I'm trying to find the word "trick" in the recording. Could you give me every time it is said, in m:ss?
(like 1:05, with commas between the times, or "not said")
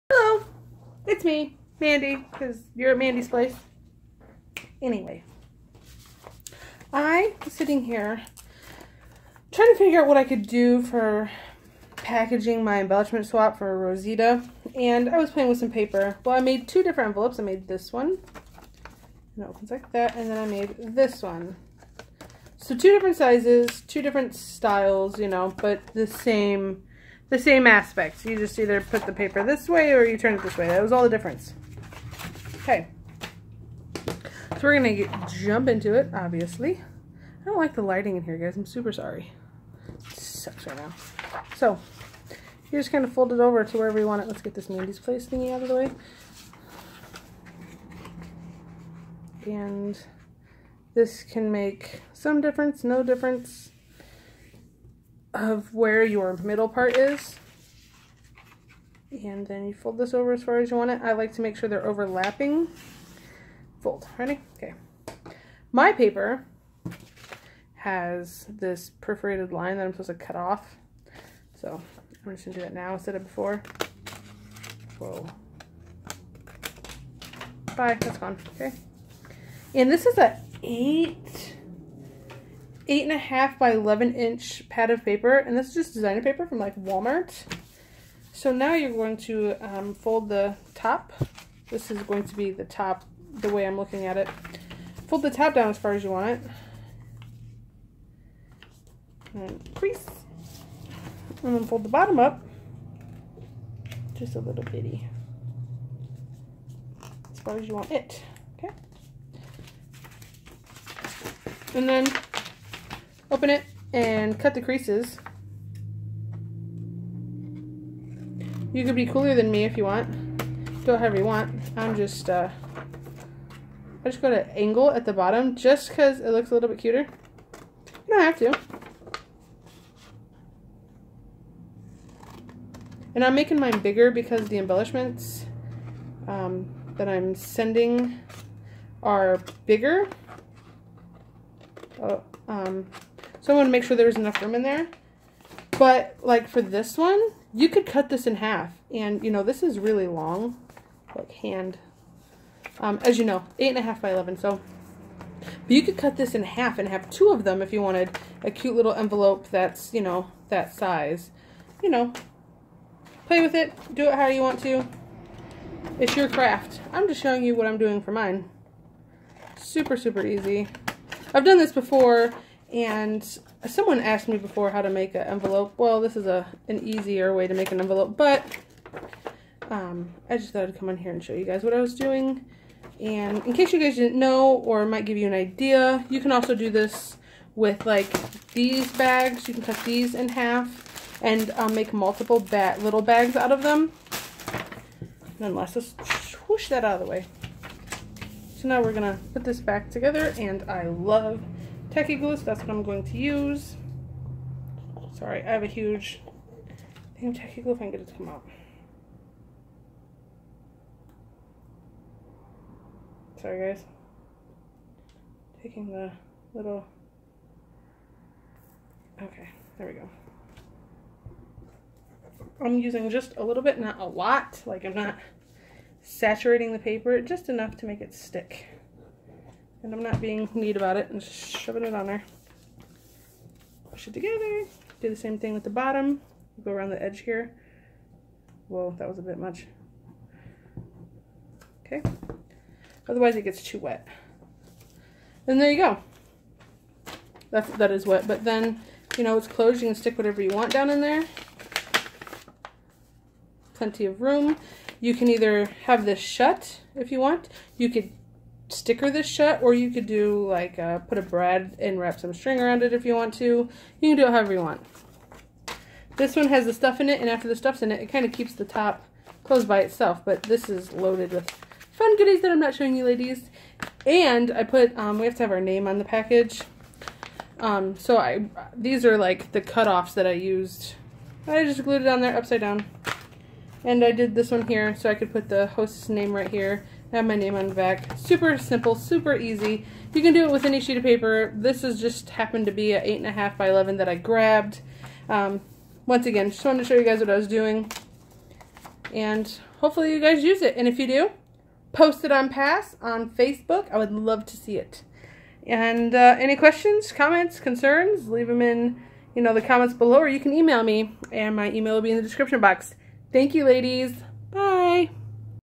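not said.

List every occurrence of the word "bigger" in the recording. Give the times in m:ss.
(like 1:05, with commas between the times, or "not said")
2:13, 2:19.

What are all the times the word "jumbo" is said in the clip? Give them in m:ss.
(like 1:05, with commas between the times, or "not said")
not said.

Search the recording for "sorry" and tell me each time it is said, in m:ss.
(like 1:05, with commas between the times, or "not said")
0:38, 3:25, 3:33.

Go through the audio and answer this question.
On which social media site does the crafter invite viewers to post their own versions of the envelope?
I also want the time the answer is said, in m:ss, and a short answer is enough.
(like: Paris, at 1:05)
Facebook, at 5:03.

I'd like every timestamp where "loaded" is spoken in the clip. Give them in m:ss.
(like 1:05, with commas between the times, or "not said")
4:30.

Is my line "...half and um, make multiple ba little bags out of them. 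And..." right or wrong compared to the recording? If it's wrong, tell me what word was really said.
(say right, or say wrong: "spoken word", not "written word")
right.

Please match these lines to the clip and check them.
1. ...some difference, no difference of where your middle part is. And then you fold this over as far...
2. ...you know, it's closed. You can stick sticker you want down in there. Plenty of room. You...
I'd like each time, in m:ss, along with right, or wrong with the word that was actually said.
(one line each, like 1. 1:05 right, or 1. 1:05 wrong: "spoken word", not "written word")
1. 0:52 right
2. 4:09 wrong: "whatever", not "sticker".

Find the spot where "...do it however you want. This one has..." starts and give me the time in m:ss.
4:24.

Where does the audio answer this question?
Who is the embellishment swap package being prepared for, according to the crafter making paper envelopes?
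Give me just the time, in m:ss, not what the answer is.
0:13.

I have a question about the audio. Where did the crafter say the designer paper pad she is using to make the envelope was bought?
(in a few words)
Walmart.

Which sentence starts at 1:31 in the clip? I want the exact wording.
This is going to be the top, the way I'm looking at it.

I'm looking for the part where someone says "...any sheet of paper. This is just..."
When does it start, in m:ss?
4:50.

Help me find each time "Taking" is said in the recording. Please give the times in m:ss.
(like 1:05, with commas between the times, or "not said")
3:35.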